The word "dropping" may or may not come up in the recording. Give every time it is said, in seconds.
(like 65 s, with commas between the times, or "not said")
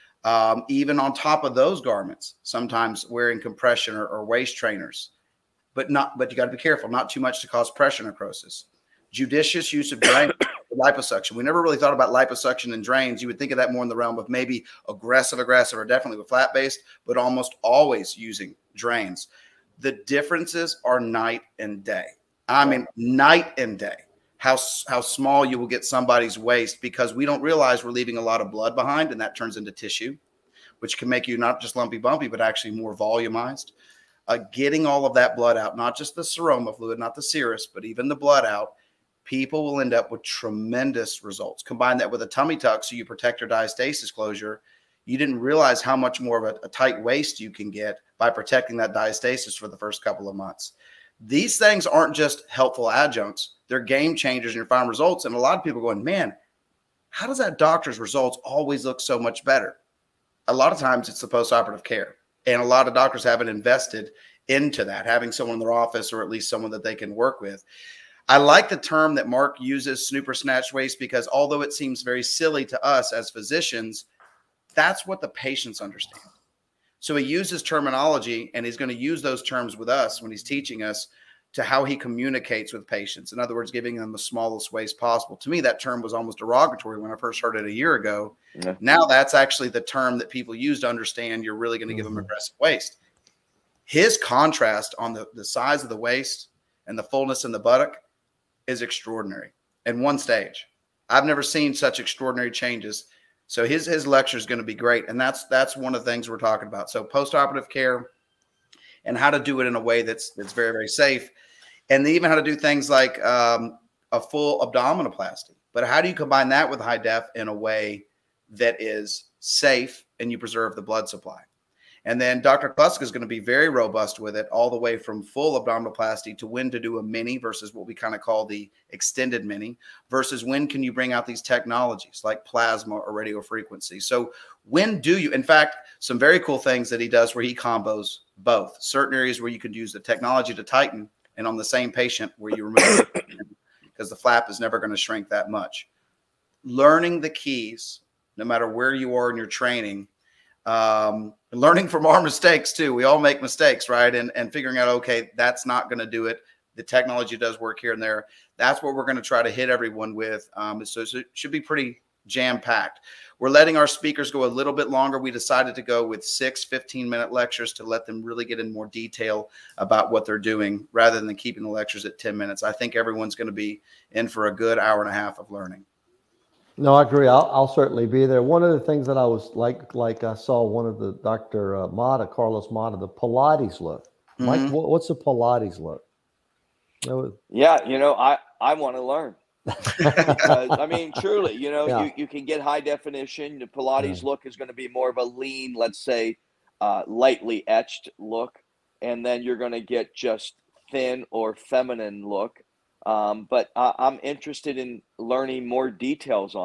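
not said.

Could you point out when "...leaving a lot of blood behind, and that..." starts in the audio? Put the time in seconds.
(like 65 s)
27 s.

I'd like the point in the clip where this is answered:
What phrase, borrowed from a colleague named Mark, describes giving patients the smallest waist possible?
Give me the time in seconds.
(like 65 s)
70 s.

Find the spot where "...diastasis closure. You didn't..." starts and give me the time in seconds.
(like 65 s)
43 s.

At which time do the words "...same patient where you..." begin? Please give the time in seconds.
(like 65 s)
141 s.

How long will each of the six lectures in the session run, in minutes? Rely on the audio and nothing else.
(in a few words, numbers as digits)
15.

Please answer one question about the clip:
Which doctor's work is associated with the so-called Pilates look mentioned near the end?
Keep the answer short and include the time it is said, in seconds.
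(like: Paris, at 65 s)
Carlos Mata, at 182 s.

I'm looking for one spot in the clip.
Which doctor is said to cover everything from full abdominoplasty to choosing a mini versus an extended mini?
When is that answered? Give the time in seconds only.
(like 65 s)
122 s.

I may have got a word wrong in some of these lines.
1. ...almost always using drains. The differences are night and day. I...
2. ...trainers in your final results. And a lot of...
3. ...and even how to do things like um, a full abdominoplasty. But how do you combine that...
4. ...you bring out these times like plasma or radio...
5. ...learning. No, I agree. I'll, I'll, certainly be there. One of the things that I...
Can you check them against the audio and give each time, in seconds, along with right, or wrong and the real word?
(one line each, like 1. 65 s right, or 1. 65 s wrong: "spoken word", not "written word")
1. 17 s right
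2. 54 s wrong: "changers", not "trainers"
3. 111 s right
4. 130 s wrong: "technologies", not "times"
5. 175 s right.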